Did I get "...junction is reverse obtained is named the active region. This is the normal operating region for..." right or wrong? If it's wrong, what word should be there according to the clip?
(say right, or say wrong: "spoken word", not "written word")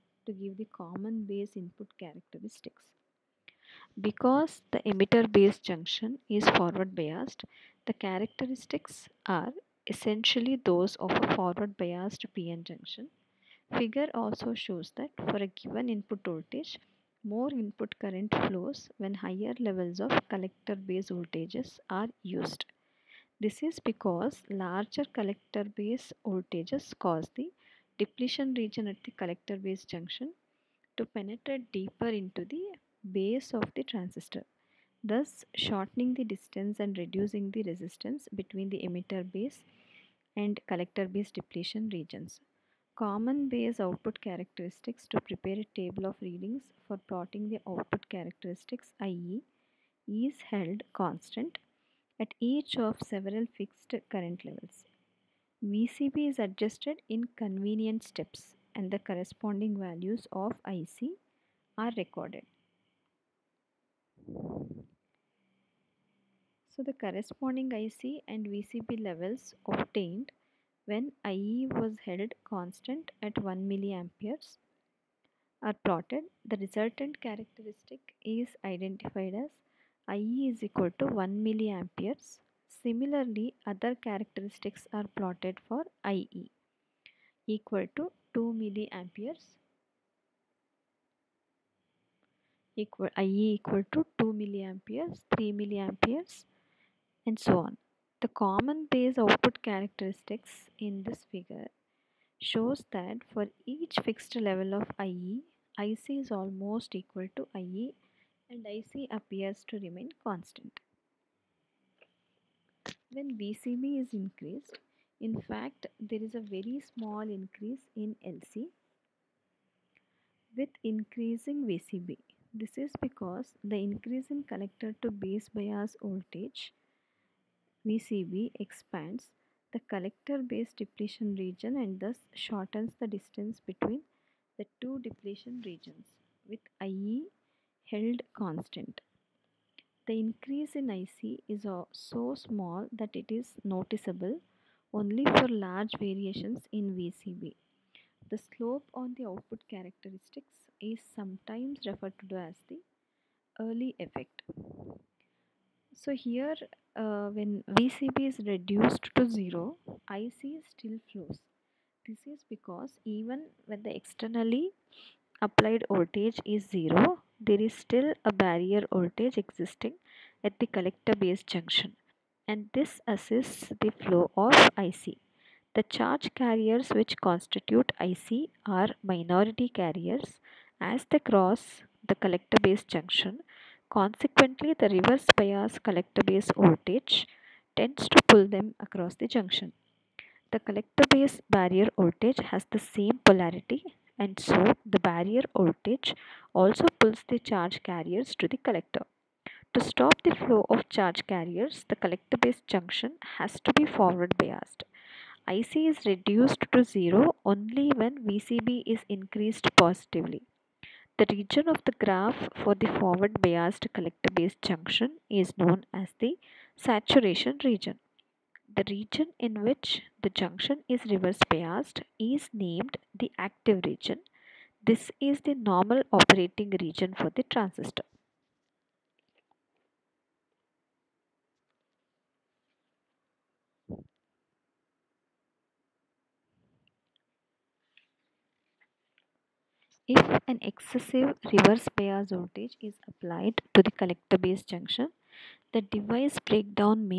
wrong: "biased", not "obtained".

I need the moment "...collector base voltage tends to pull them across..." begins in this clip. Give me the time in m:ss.
3:05.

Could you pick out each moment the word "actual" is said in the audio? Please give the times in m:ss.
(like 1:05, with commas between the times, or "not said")
not said.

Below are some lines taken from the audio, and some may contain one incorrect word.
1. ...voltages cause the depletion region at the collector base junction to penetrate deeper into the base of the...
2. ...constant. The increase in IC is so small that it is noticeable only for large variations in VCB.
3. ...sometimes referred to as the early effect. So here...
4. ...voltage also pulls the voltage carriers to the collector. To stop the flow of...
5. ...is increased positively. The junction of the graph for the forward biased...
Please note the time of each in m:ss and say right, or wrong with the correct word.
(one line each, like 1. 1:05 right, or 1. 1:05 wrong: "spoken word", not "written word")
1. 0:26 right
2. 2:18 right
3. 2:31 right
4. 3:15 wrong: "charge", not "voltage"
5. 3:28 wrong: "region", not "junction".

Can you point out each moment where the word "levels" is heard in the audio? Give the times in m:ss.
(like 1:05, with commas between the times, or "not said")
0:19, 0:54, 1:09, 1:44.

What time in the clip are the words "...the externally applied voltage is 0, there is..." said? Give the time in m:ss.
2:43.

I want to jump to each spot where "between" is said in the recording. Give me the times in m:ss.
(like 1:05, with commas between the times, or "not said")
0:38, 2:13.